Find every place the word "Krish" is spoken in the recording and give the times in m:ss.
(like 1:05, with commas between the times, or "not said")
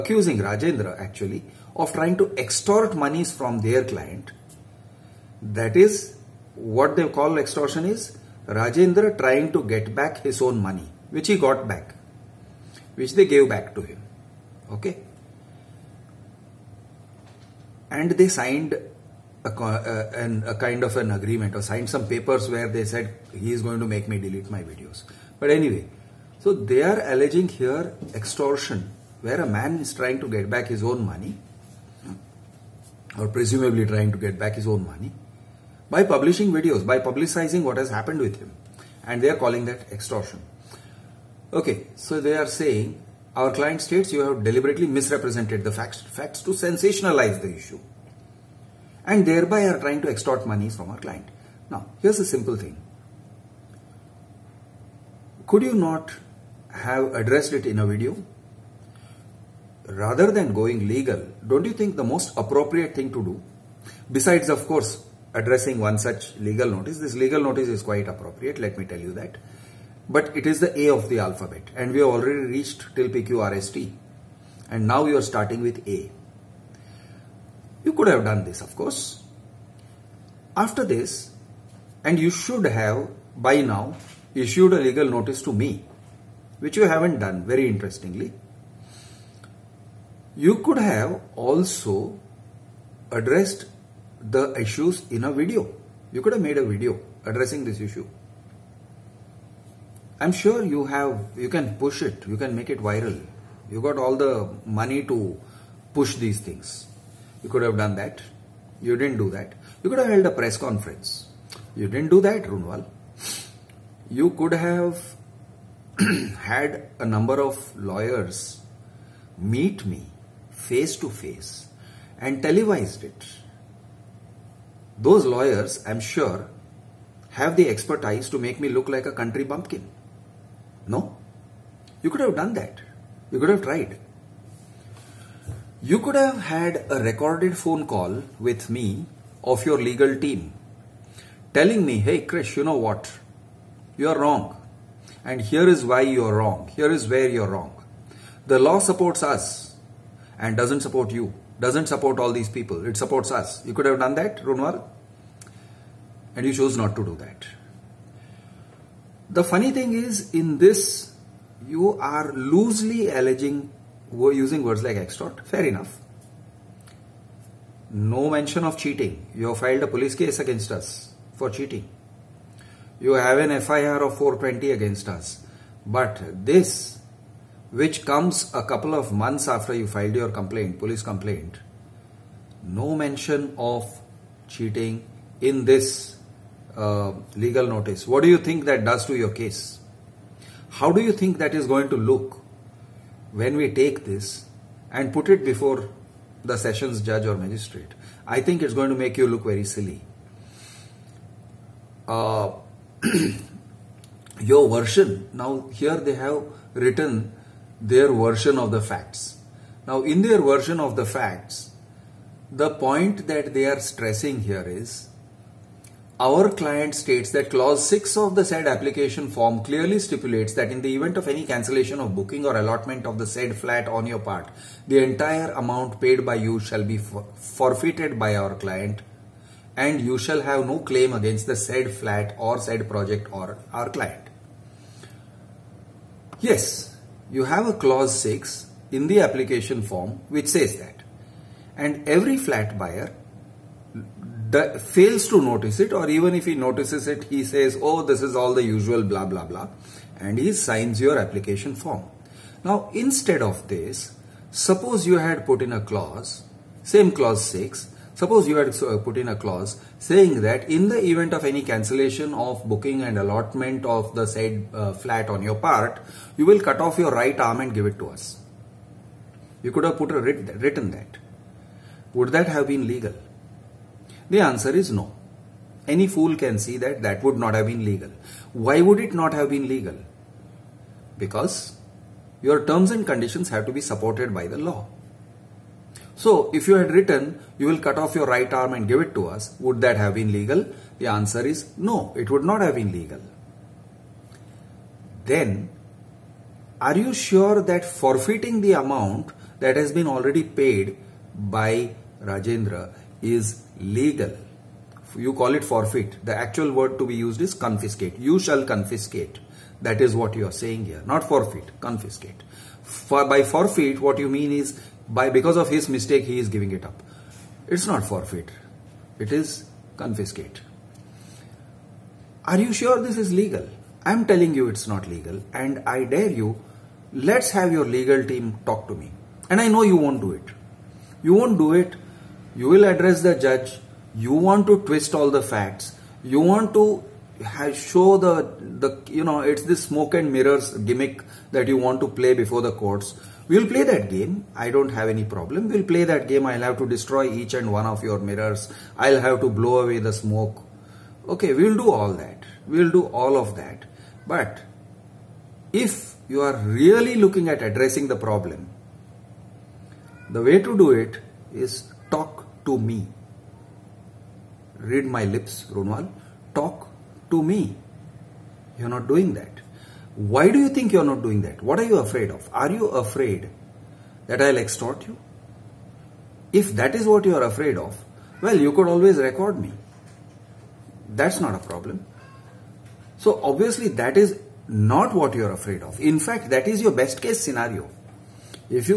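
2:22.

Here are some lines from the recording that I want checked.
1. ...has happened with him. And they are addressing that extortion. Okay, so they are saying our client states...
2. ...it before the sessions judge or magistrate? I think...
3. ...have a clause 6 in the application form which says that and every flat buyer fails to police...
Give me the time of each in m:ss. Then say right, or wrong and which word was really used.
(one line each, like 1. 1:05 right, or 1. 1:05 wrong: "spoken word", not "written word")
1. 0:37 wrong: "calling", not "addressing"
2. 3:15 right
3. 3:57 wrong: "notice", not "police".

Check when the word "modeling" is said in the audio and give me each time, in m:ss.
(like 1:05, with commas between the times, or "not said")
not said.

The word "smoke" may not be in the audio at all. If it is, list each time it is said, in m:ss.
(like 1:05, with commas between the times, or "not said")
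5:39, 5:50.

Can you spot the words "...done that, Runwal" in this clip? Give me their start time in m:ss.
2:33.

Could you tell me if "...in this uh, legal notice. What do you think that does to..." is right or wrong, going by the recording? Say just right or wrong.
right.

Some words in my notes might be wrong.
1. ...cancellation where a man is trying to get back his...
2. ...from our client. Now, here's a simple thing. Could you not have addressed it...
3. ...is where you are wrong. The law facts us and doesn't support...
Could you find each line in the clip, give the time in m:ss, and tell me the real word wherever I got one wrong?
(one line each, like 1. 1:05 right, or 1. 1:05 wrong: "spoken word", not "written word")
1. 0:28 wrong: "extortion", not "cancellation"
2. 0:50 right
3. 2:26 wrong: "supports", not "facts".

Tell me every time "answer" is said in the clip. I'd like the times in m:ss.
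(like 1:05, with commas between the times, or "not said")
4:34, 4:51.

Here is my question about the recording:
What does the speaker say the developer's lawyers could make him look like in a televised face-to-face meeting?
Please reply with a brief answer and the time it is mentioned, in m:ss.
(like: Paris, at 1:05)
Country bumpkin, at 2:09.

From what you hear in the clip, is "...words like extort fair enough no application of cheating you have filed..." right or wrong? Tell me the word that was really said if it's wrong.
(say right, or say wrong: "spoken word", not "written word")
wrong: "mention", not "application".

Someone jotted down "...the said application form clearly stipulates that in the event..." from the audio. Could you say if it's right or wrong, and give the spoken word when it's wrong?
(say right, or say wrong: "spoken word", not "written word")
right.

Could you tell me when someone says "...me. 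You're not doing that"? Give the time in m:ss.
6:07.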